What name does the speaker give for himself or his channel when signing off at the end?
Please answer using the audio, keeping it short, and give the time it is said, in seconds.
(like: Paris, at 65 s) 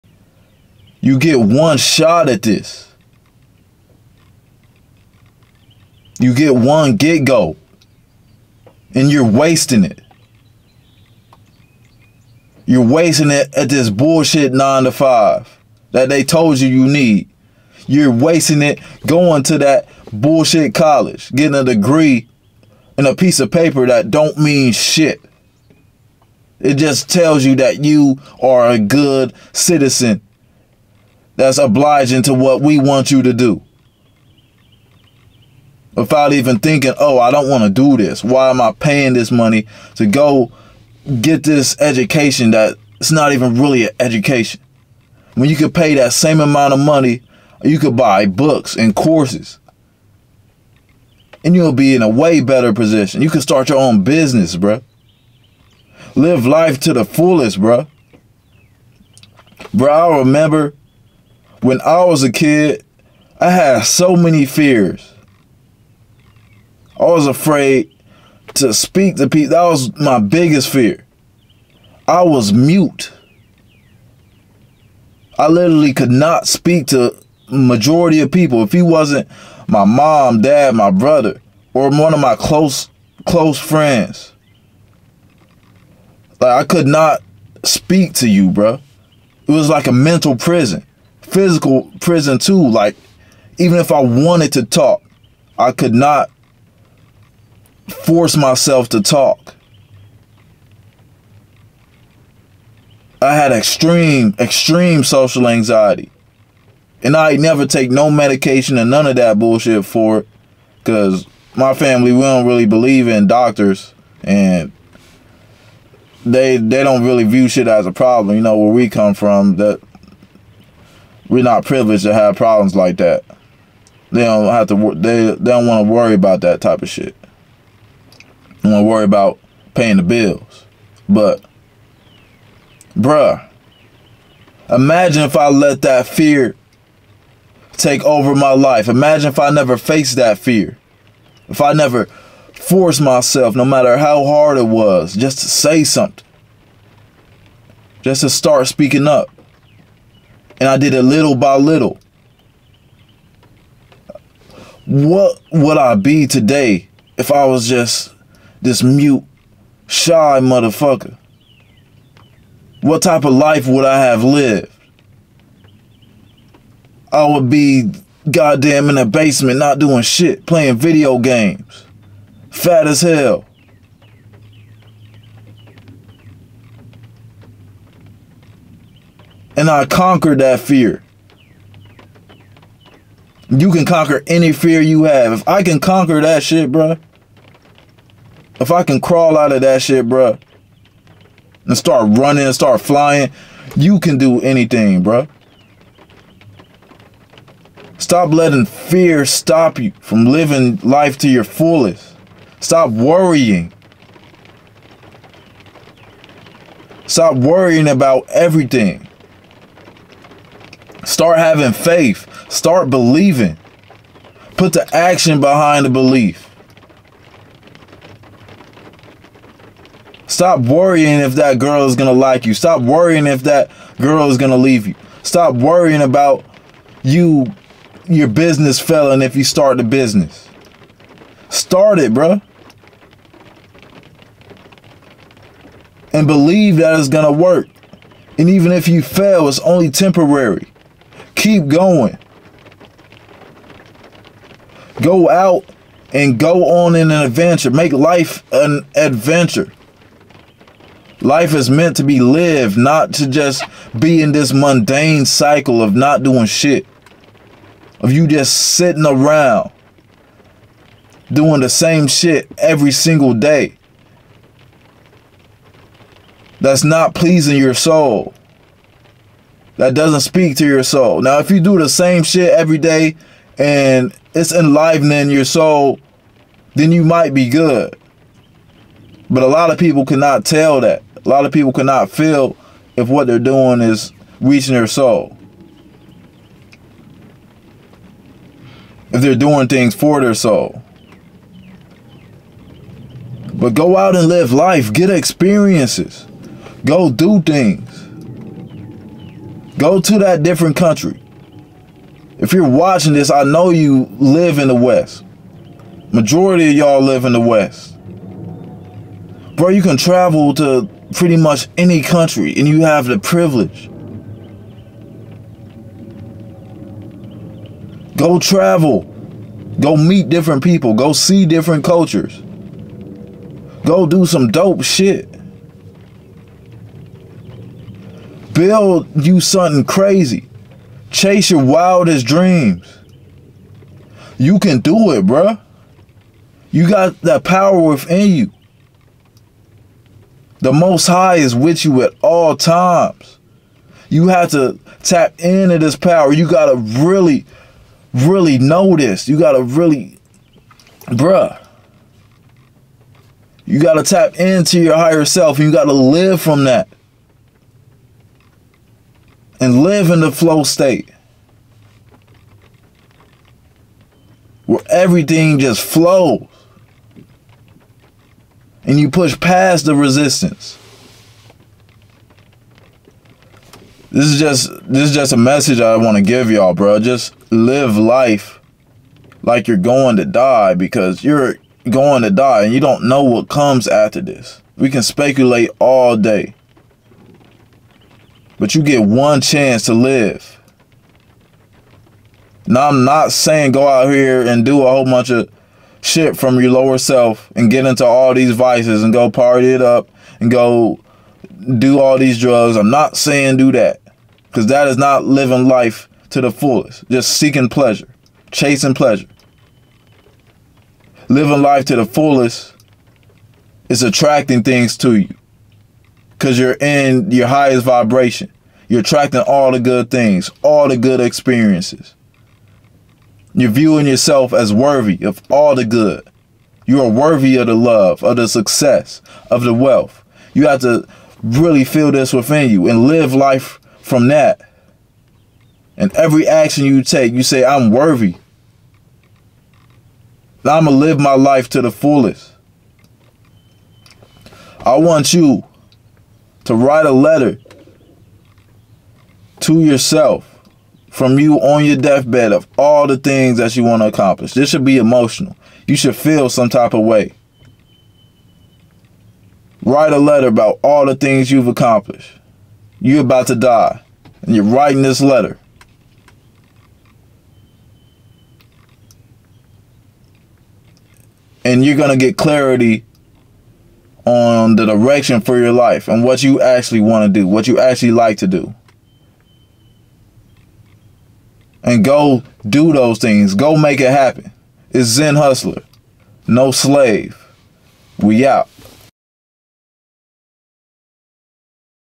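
Zen Hustler, at 485 s.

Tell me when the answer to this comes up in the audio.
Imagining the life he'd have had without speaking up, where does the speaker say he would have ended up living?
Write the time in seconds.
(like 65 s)
168 s.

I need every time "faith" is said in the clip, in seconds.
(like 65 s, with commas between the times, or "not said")
211 s.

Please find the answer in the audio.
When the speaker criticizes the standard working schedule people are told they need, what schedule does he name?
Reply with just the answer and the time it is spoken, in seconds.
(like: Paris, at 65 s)
nine to five, at 14 s.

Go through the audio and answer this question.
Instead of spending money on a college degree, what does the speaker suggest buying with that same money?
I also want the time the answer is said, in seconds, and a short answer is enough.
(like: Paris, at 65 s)
books and courses, at 48 s.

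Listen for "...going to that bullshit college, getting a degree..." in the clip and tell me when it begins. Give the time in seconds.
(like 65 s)
19 s.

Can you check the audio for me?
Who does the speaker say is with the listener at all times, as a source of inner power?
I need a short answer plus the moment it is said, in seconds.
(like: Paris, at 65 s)
The Most High, at 340 s.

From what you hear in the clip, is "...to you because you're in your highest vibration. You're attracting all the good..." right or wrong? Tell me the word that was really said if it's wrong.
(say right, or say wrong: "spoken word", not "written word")
right.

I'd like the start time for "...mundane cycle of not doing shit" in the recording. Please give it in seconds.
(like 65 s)
254 s.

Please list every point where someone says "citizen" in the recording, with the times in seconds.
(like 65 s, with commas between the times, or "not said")
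29 s.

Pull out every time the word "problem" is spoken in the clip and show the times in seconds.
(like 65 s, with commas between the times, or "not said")
117 s, 122 s.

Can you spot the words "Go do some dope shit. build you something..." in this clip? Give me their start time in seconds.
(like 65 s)
323 s.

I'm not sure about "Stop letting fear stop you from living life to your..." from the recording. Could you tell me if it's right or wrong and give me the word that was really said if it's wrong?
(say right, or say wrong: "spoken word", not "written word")
right.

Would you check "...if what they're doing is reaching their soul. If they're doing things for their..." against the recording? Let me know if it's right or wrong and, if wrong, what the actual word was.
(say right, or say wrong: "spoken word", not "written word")
right.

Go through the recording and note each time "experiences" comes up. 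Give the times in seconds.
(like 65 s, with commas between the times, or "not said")
295 s, 421 s.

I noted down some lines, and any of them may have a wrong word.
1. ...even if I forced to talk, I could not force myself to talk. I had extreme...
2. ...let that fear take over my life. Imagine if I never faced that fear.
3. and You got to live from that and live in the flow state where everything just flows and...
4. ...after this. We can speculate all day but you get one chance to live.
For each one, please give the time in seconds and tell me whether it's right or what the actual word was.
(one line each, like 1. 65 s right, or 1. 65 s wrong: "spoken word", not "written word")
1. 93 s wrong: "wanted", not "forced"
2. 135 s right
3. 355 s right
4. 383 s right.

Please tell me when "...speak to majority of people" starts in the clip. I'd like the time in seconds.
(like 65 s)
76 s.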